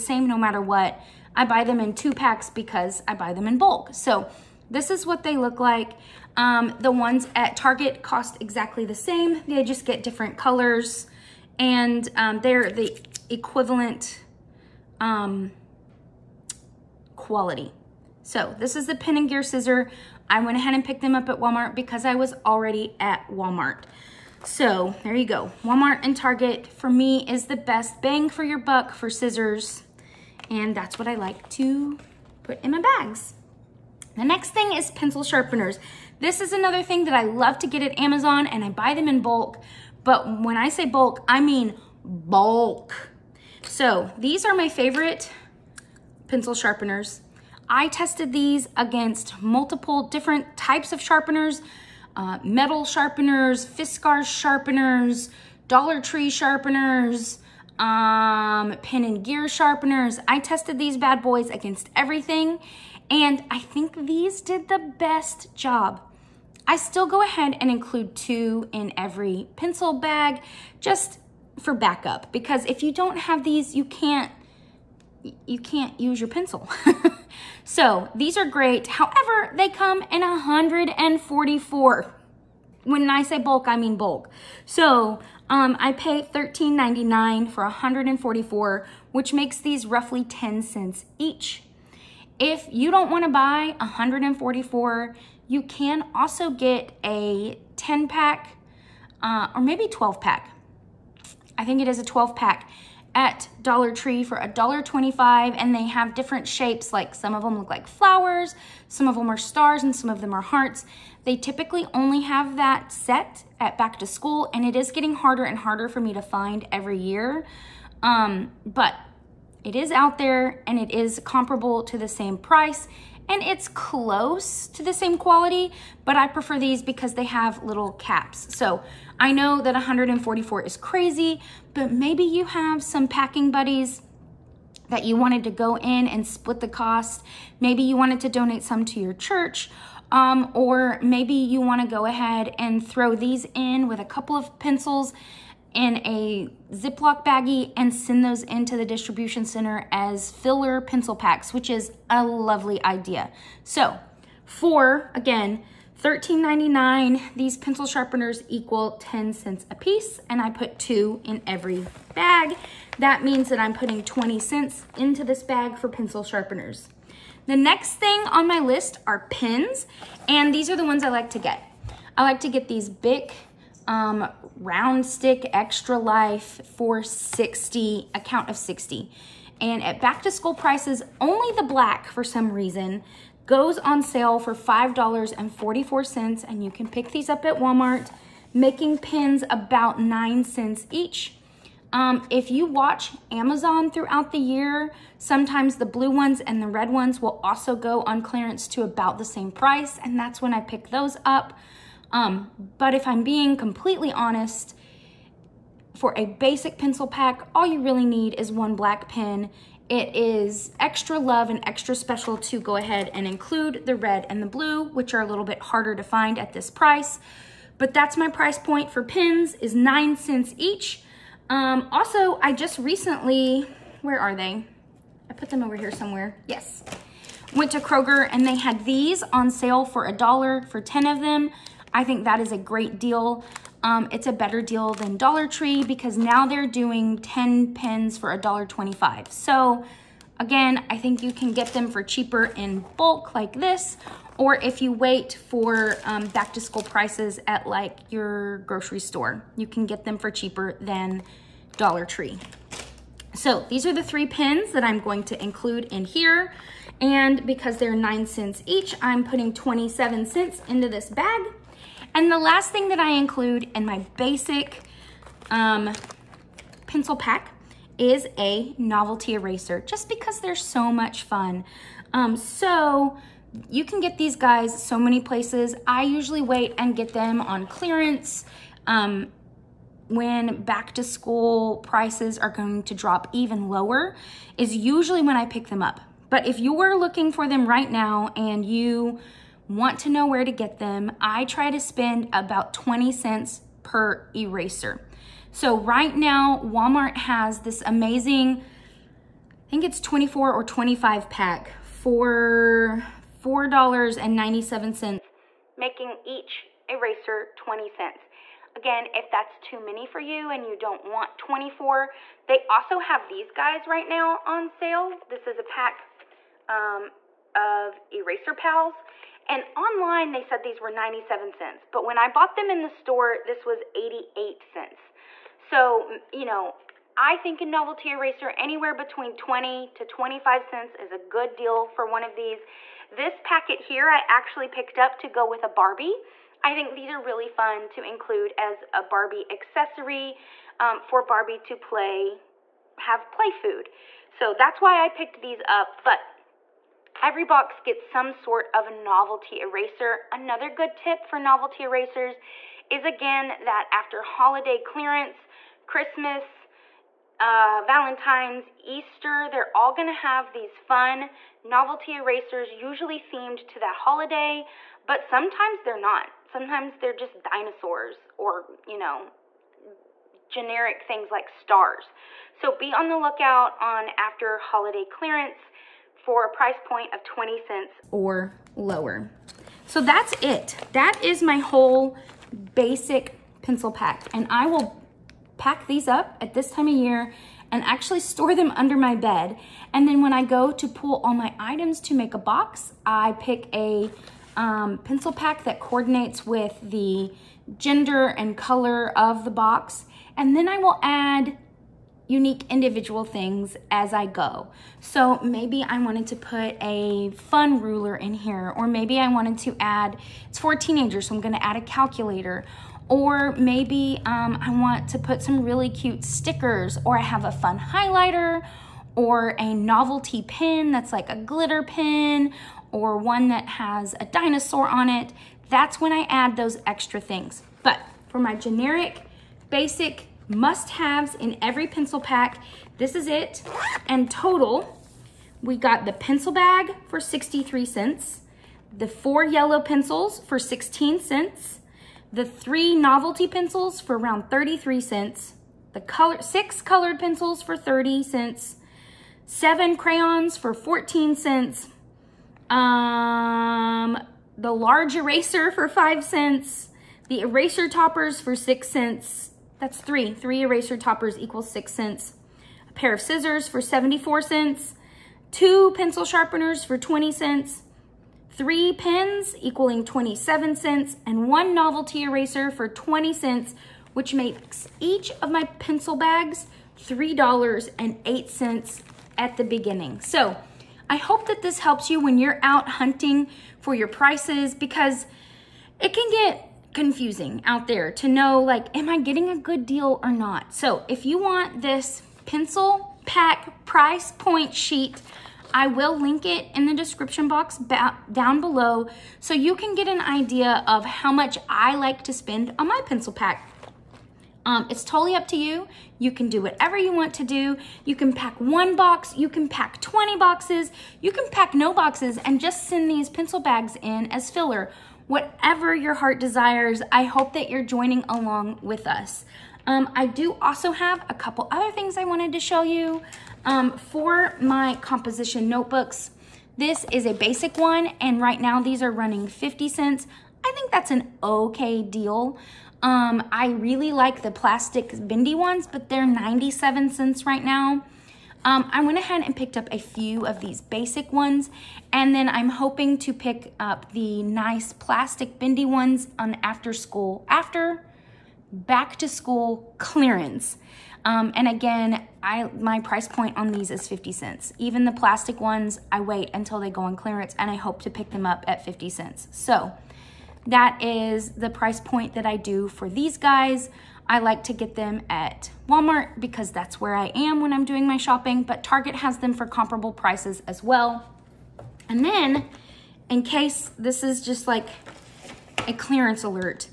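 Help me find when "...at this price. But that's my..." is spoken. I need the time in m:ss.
3:36.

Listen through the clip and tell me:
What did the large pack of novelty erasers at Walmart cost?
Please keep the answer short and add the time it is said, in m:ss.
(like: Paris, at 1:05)
$4.97, at 5:03.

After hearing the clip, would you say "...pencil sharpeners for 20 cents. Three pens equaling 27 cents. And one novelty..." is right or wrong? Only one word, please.
right.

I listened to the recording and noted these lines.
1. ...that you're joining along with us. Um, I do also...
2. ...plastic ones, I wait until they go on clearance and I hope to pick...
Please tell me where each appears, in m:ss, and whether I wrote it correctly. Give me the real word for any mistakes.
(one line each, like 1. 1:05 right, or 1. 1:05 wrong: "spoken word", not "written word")
1. 8:37 right
2. 9:15 right.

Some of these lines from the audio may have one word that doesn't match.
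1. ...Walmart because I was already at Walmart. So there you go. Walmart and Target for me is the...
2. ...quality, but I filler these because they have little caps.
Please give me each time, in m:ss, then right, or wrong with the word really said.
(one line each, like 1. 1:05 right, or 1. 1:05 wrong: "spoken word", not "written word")
1. 0:21 right
2. 2:05 wrong: "prefer", not "filler".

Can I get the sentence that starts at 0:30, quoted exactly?
And that's what I like to put in my bags.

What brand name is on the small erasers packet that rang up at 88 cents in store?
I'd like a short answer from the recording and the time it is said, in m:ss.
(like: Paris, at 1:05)
Eraser Pals, at 5:18.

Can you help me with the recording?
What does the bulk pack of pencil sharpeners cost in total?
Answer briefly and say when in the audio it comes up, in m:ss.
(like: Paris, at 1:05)
$13.99, at 1:25.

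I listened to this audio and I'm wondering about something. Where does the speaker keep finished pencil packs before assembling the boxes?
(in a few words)
Under my bed.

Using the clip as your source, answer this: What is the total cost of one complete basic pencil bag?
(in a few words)
$3.08.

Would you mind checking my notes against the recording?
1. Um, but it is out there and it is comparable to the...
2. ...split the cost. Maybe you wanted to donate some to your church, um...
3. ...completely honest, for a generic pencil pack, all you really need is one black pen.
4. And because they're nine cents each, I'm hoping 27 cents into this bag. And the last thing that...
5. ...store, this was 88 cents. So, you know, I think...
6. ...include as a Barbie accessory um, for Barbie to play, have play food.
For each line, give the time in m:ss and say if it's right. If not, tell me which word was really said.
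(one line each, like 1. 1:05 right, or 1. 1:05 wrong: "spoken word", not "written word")
1. 1:58 right
2. 2:16 right
3. 3:23 wrong: "basic", not "generic"
4. 4:17 wrong: "putting", not "hoping"
5. 5:22 right
6. 5:38 right.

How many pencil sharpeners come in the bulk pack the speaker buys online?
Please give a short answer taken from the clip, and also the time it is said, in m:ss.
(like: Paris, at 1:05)
144, at 1:19.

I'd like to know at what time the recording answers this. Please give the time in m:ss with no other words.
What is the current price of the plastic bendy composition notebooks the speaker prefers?
8:56.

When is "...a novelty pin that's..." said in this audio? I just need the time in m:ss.
6:59.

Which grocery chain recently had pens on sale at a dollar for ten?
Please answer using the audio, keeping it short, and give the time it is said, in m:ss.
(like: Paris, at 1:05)
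Kroger, at 3:47.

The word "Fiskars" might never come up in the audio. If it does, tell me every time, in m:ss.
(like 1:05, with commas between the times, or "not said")
0:53.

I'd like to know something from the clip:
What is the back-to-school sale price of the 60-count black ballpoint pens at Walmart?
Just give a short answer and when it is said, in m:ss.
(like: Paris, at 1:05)
$5.44, at 3:04.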